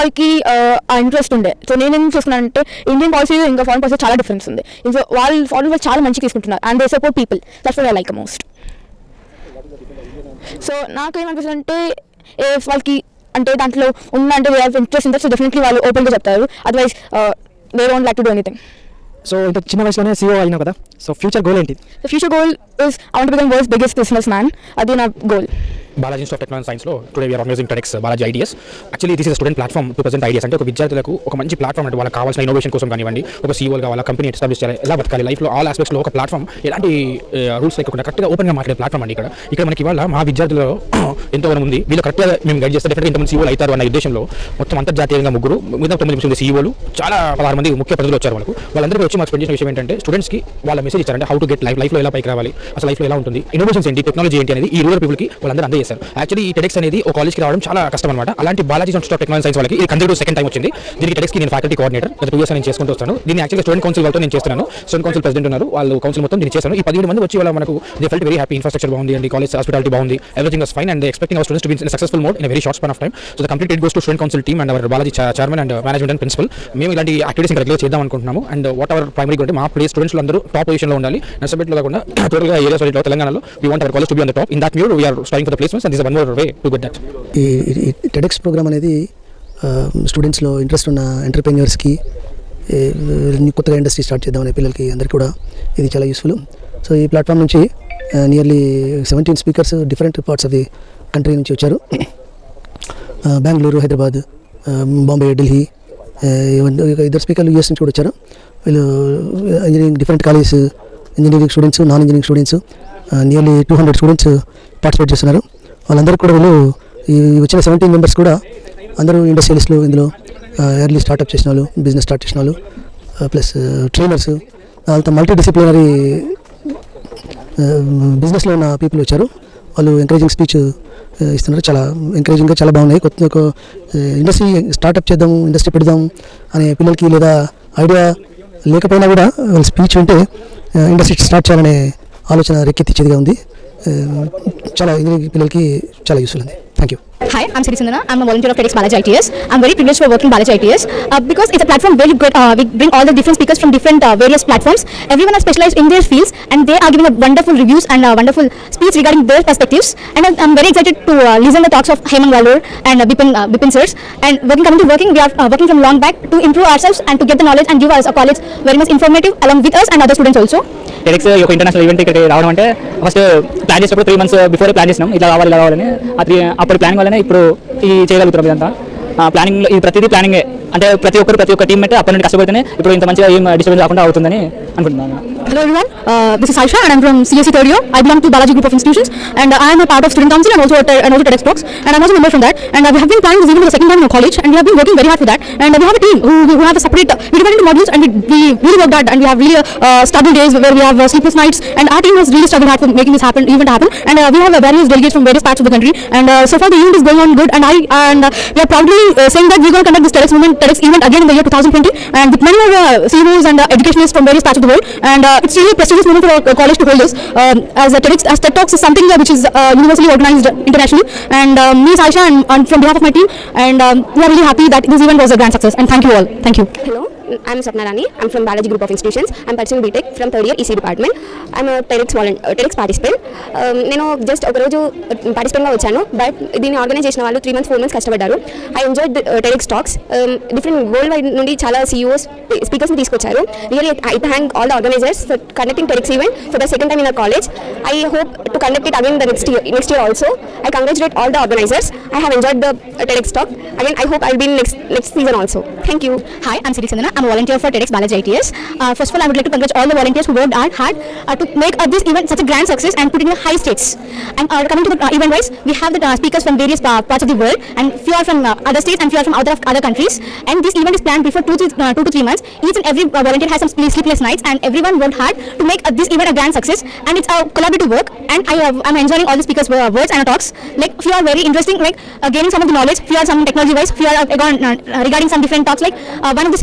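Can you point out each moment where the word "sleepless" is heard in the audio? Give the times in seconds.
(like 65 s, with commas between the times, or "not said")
201 s, 273 s.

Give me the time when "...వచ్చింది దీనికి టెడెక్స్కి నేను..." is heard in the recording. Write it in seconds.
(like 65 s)
60 s.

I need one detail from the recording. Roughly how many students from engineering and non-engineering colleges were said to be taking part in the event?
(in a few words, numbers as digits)
200.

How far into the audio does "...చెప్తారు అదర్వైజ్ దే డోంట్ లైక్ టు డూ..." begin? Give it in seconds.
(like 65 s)
16 s.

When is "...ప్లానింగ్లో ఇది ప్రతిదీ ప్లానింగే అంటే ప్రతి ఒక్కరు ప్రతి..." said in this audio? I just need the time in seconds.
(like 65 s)
179 s.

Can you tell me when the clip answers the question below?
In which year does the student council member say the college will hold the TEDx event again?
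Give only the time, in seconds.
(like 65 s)
211 s.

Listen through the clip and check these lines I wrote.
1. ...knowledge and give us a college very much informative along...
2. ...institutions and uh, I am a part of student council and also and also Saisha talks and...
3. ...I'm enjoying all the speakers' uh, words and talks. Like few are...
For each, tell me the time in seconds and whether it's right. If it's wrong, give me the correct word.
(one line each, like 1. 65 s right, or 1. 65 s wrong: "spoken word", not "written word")
1. 167 s right
2. 188 s wrong: "TEDx", not "Saisha"
3. 278 s right.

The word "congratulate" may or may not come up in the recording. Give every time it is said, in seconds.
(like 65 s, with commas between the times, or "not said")
250 s, 259 s.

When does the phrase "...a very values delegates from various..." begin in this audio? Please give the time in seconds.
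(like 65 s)
204 s.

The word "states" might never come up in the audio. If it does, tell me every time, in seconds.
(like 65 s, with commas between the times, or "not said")
263 s, 268 s.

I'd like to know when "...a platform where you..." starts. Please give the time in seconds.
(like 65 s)
151 s.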